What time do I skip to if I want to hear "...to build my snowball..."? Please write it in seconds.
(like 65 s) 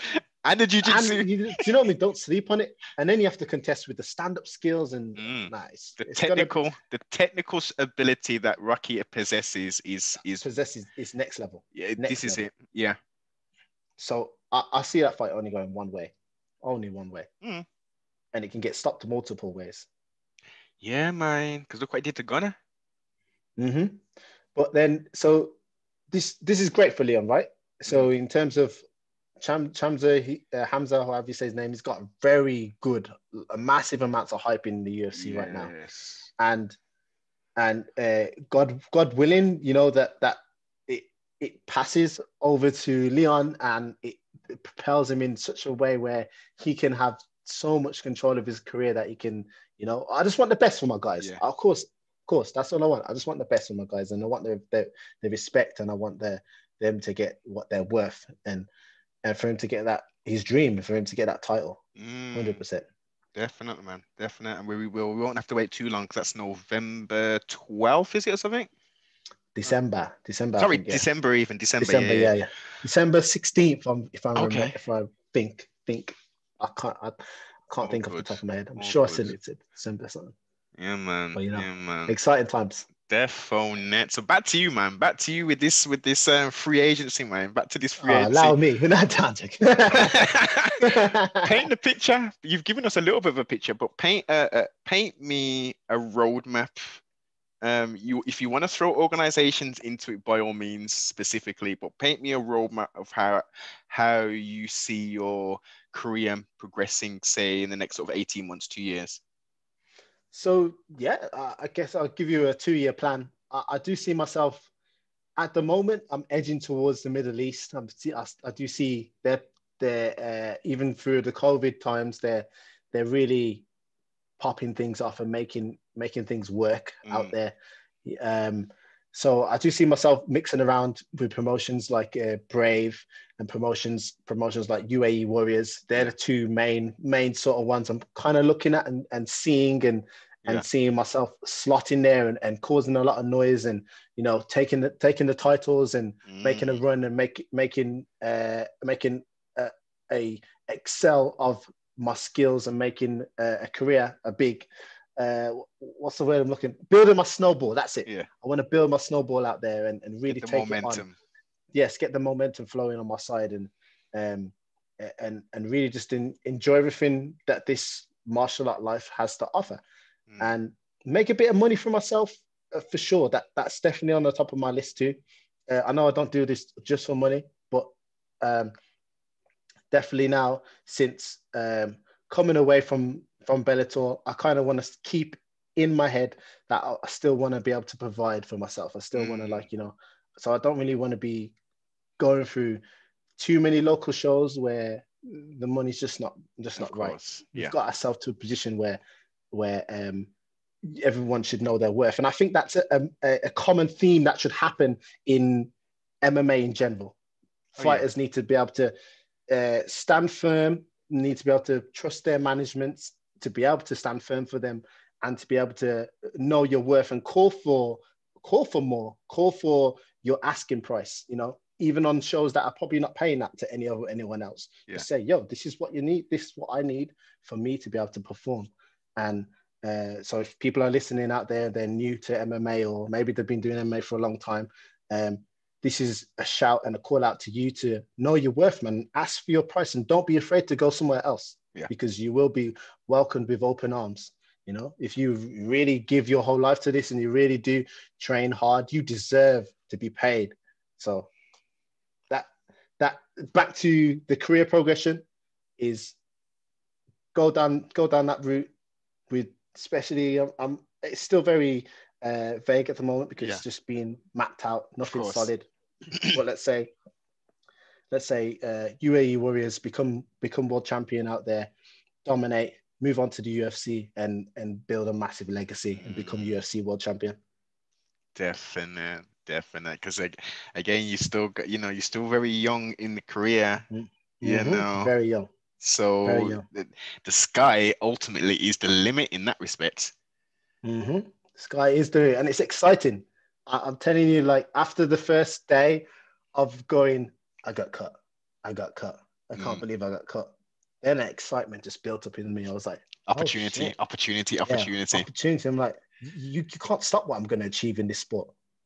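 158 s.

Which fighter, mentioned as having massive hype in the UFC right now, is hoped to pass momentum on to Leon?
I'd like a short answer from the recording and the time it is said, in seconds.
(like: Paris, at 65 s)
Hamza, at 30 s.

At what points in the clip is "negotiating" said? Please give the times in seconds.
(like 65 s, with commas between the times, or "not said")
not said.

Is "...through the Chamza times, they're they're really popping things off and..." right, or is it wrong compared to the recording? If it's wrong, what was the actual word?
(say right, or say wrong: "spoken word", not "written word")
wrong: "COVID", not "Chamza".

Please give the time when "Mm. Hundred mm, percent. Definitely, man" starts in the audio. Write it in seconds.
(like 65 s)
61 s.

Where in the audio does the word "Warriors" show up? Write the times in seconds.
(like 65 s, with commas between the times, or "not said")
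135 s, 269 s.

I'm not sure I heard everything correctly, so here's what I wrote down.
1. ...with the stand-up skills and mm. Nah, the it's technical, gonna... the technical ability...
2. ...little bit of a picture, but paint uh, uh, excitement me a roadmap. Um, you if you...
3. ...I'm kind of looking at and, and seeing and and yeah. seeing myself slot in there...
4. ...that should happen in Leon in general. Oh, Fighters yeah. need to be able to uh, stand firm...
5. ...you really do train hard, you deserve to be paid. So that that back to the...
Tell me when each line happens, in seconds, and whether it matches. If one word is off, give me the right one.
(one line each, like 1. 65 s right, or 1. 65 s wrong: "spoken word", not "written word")
1. 3 s right
2. 93 s wrong: "paint", not "excitement"
3. 137 s right
4. 204 s wrong: "MMA", not "Leon"
5. 247 s right.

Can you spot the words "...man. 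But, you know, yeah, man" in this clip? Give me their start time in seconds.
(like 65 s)
80 s.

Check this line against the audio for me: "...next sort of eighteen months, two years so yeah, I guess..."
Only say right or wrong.
right.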